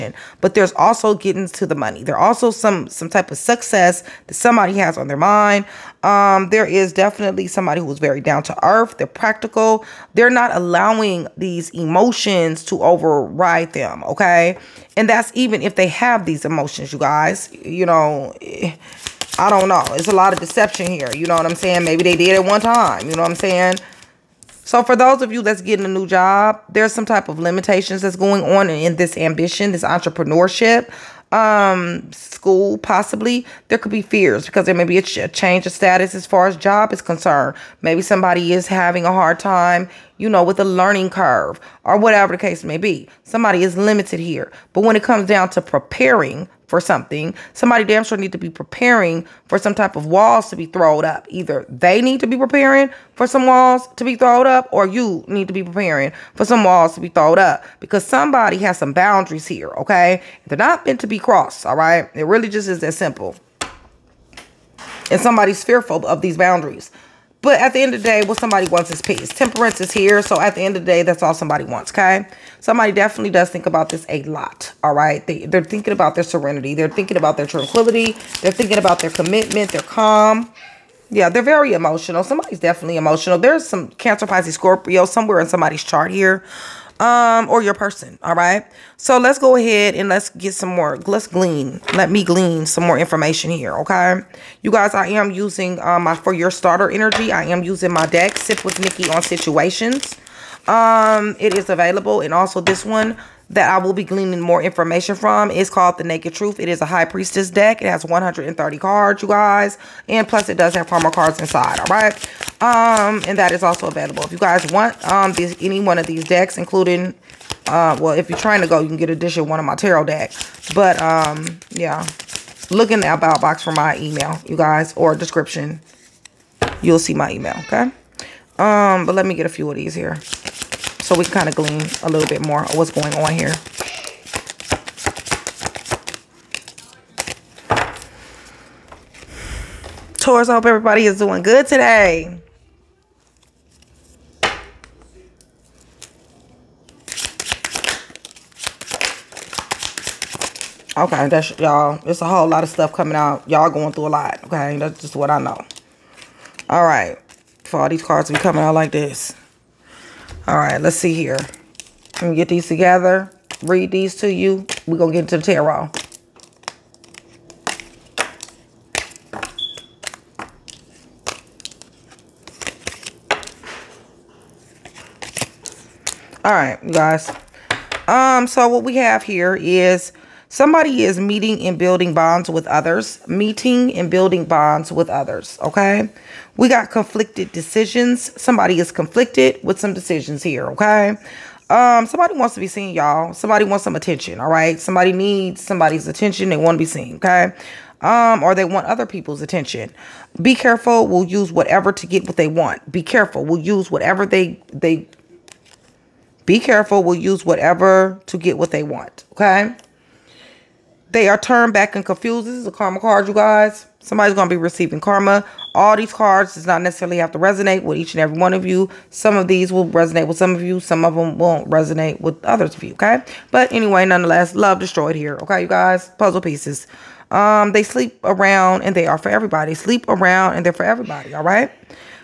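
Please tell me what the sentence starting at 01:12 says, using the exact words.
Somebody definitely does think about this a lot, all right?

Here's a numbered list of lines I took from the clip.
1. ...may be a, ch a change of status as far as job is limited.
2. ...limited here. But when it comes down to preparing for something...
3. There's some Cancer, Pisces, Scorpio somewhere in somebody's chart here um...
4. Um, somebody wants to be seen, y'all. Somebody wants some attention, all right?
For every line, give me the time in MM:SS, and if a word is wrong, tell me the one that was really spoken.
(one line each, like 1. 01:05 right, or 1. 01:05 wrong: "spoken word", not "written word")
1. 00:34 wrong: "concerned", not "limited"
2. 00:43 right
3. 01:23 right
4. 03:11 right.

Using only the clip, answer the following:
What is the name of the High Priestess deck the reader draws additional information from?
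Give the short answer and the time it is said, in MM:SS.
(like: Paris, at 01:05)
The Naked Truth, at 01:45.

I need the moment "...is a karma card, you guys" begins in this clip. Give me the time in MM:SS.
03:32.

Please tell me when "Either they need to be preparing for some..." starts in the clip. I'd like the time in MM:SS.
00:51.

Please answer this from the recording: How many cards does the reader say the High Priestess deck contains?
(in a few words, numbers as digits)
130.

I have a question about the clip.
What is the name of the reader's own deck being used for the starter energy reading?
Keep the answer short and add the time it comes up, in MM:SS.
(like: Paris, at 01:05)
Sip with Nikki on Situations, at 01:38.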